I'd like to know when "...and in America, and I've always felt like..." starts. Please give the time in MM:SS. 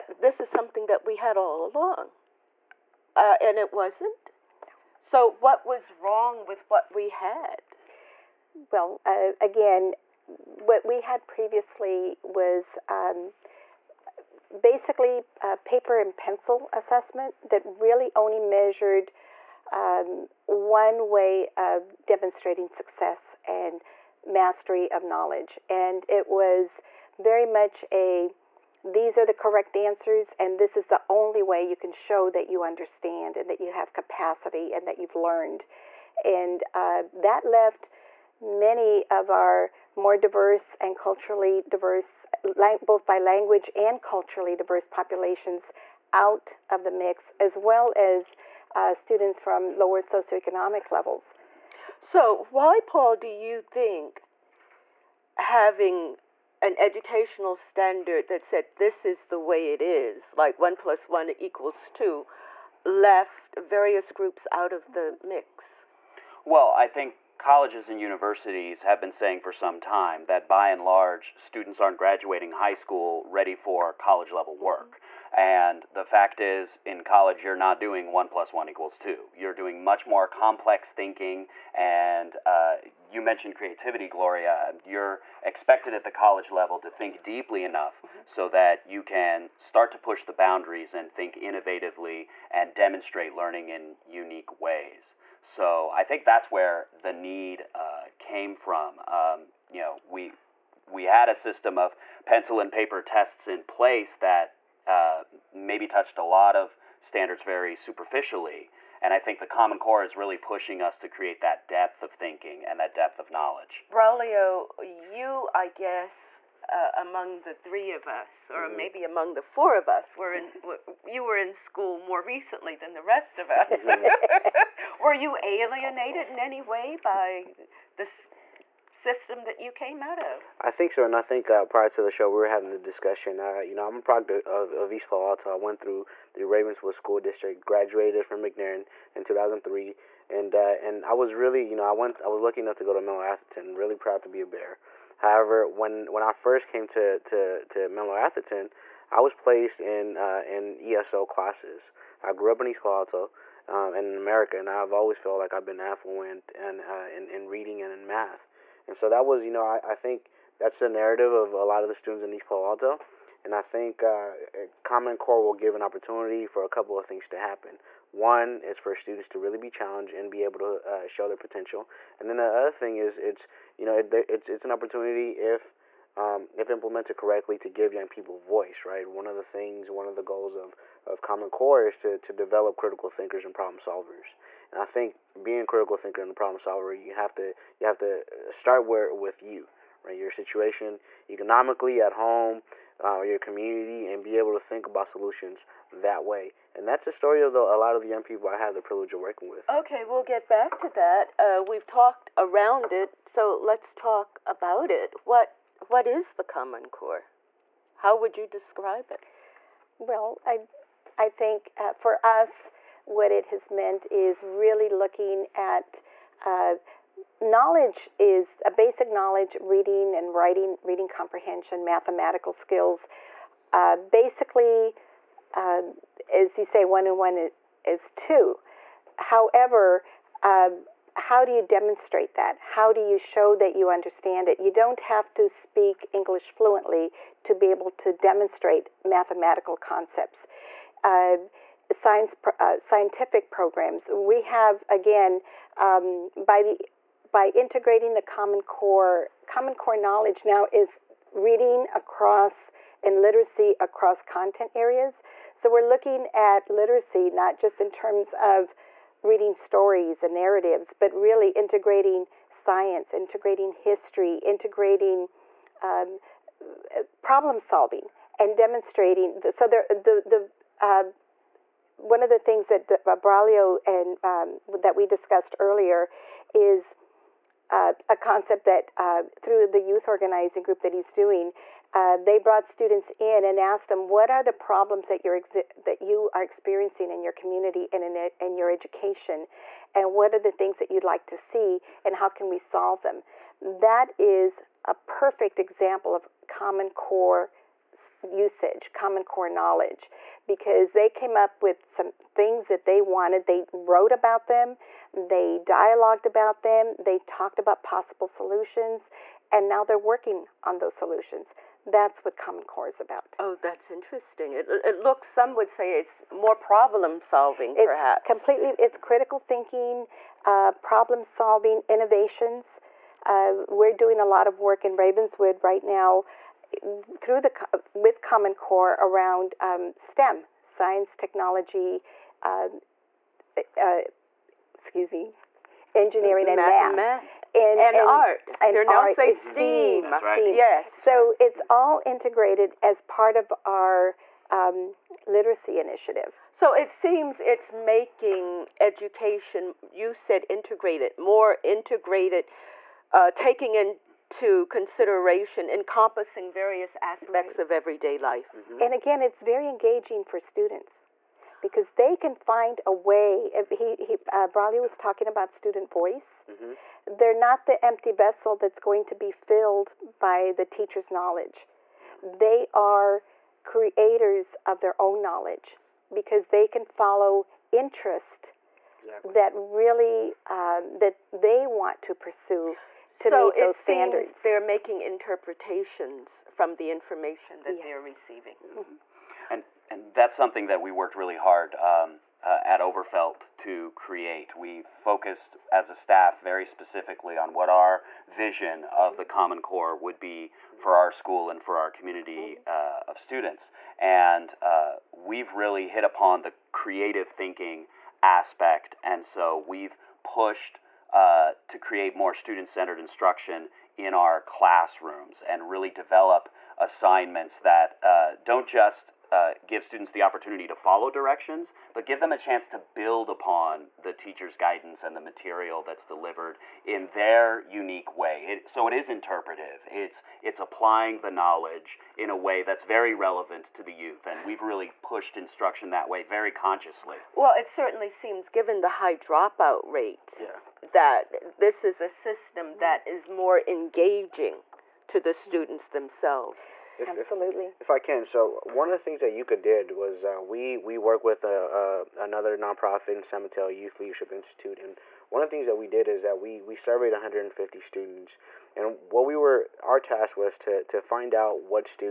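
02:33.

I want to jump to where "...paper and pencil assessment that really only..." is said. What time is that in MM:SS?
00:15.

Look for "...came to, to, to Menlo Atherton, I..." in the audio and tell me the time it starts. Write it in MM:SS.
02:26.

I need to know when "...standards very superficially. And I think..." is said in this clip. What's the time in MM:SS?
01:47.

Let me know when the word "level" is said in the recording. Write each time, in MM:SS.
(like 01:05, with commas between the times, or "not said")
00:50, 01:14, 01:26.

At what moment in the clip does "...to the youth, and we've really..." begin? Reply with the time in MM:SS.
07:13.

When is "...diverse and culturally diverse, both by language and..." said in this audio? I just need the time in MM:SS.
00:40.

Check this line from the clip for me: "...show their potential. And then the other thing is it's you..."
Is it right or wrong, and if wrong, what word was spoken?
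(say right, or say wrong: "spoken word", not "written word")
right.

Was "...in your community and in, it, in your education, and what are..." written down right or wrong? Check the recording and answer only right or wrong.
right.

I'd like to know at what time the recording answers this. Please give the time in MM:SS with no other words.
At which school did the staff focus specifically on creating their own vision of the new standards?
06:32.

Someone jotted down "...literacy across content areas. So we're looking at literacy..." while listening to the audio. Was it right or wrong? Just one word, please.
right.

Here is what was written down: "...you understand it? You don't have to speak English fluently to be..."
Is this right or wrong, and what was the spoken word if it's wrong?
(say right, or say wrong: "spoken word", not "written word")
right.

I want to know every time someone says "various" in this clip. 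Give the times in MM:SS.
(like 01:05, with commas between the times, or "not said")
01:03, 05:56.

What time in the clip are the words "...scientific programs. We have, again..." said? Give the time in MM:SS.
04:02.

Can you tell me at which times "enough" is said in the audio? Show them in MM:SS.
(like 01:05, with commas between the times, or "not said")
01:27, 02:22.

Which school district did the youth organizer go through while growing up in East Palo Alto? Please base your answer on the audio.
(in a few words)
Ravenswood School District.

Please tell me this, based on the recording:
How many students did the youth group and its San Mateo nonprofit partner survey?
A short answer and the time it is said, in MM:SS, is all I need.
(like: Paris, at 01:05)
150, at 07:37.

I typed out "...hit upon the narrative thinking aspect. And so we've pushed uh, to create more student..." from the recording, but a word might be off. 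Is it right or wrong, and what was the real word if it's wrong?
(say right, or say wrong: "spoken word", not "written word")
wrong: "creative", not "narrative".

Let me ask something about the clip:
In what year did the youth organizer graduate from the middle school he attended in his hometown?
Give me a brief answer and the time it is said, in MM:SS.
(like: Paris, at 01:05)
2003, at 02:19.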